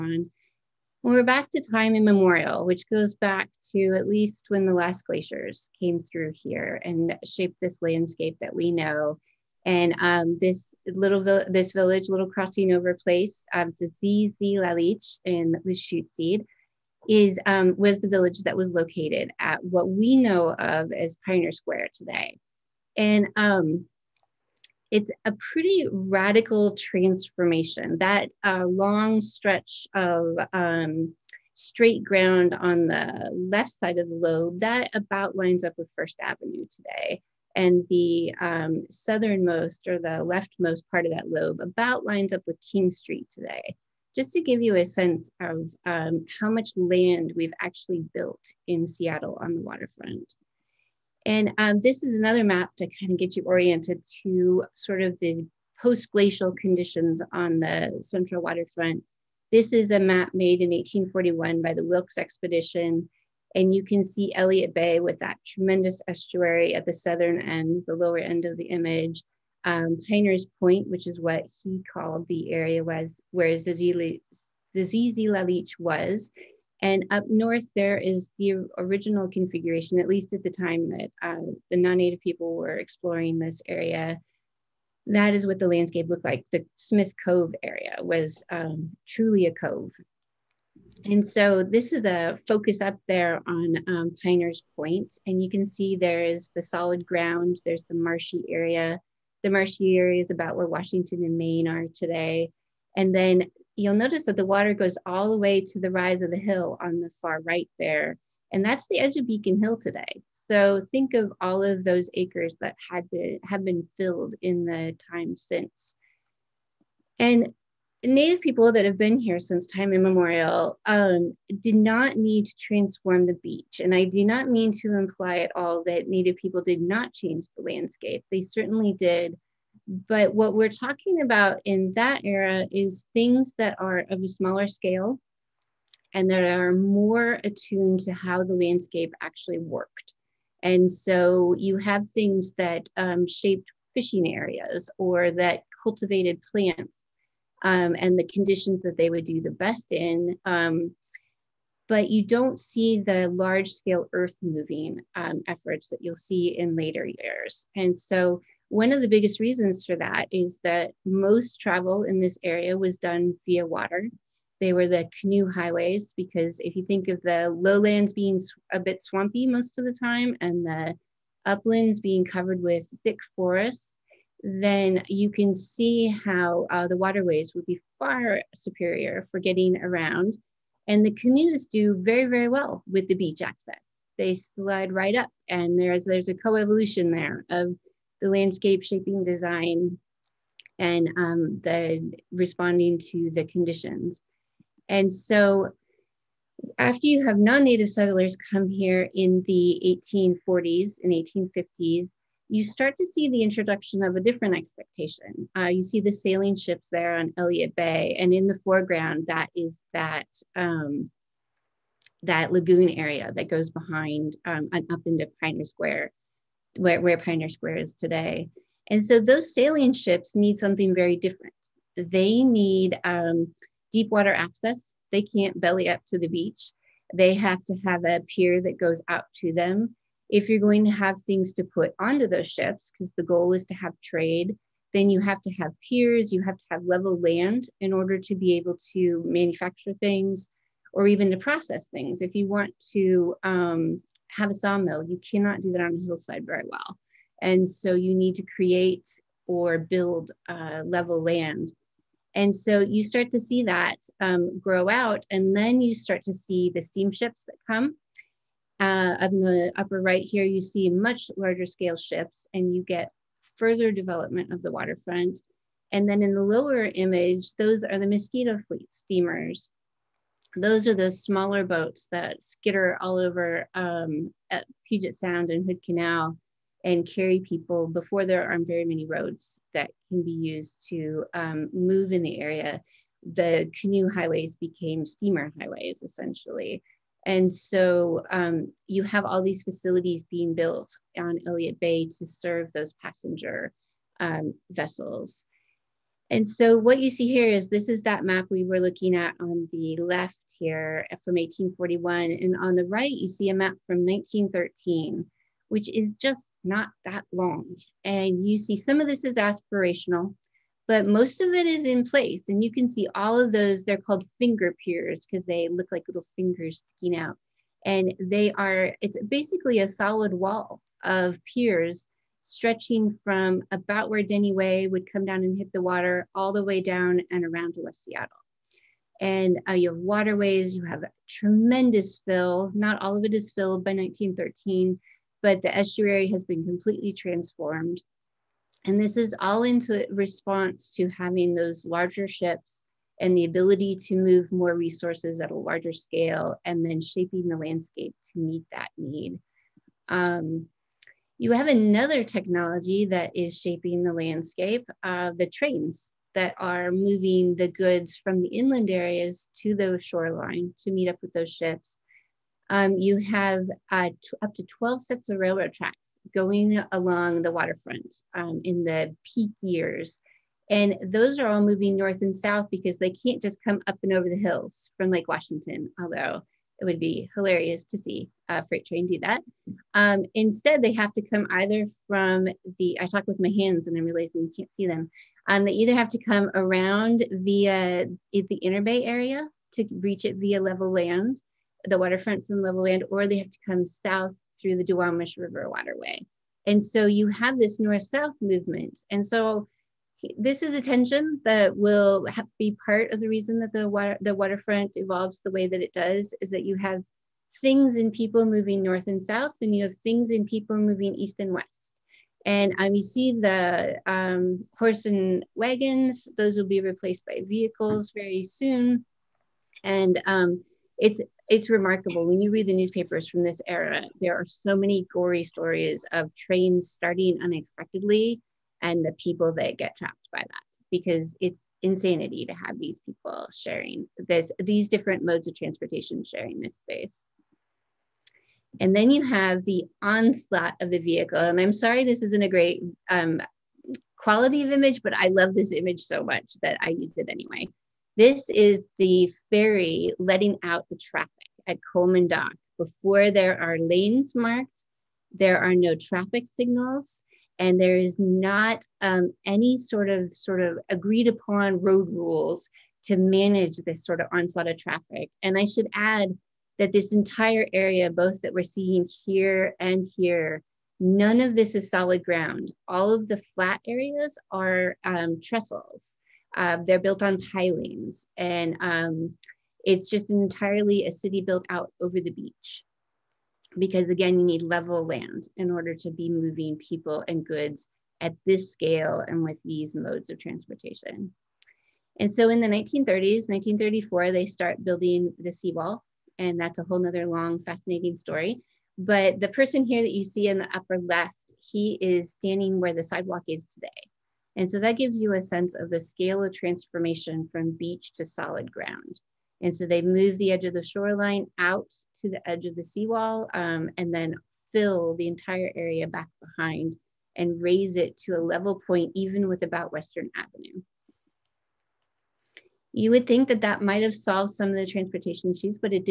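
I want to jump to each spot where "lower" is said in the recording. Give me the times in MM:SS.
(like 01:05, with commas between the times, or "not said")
01:07, 04:26.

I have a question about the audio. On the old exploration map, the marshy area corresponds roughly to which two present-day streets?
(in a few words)
Washington and Main.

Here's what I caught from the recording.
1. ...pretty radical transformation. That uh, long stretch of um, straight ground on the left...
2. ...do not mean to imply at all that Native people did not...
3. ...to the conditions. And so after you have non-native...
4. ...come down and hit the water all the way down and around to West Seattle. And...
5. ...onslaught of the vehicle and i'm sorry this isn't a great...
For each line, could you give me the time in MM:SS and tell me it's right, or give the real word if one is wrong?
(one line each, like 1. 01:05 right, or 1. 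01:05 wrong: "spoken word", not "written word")
1. 00:25 right
2. 02:04 right
3. 03:13 right
4. 05:25 right
5. 07:20 right.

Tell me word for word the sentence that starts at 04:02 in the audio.
If you want to um, have a sawmill, you cannot do that on a hillside very well.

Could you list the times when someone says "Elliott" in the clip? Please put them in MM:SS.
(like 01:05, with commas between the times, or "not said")
01:04, 03:27, 04:51.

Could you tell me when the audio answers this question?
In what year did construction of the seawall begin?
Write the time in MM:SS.
08:13.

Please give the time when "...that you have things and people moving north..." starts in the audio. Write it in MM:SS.
06:46.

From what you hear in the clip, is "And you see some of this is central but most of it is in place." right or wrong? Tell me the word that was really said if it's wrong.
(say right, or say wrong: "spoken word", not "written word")
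wrong: "aspirational", not "central".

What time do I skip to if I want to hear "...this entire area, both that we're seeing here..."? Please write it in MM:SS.
07:46.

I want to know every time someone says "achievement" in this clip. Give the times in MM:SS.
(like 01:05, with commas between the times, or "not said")
not said.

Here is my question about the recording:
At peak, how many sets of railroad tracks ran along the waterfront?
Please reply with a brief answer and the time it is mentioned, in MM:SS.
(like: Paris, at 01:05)
12, at 06:04.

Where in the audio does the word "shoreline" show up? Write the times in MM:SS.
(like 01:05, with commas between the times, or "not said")
06:00, 08:30.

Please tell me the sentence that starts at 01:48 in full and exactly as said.
And that's the edge of Beacon Hill today.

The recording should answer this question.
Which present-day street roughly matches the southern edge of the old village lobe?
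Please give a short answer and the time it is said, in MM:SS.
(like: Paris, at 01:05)
King Street, at 00:42.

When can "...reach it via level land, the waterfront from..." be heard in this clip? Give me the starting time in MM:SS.
06:30.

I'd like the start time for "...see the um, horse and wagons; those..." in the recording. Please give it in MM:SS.
06:53.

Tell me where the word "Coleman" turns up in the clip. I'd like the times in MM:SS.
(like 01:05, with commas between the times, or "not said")
07:31.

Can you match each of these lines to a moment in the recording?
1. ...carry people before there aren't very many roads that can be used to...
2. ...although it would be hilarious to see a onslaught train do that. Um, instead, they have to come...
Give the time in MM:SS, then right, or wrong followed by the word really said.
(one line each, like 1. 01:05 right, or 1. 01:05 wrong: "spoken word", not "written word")
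1. 04:37 right
2. 06:16 wrong: "freight", not "onslaught".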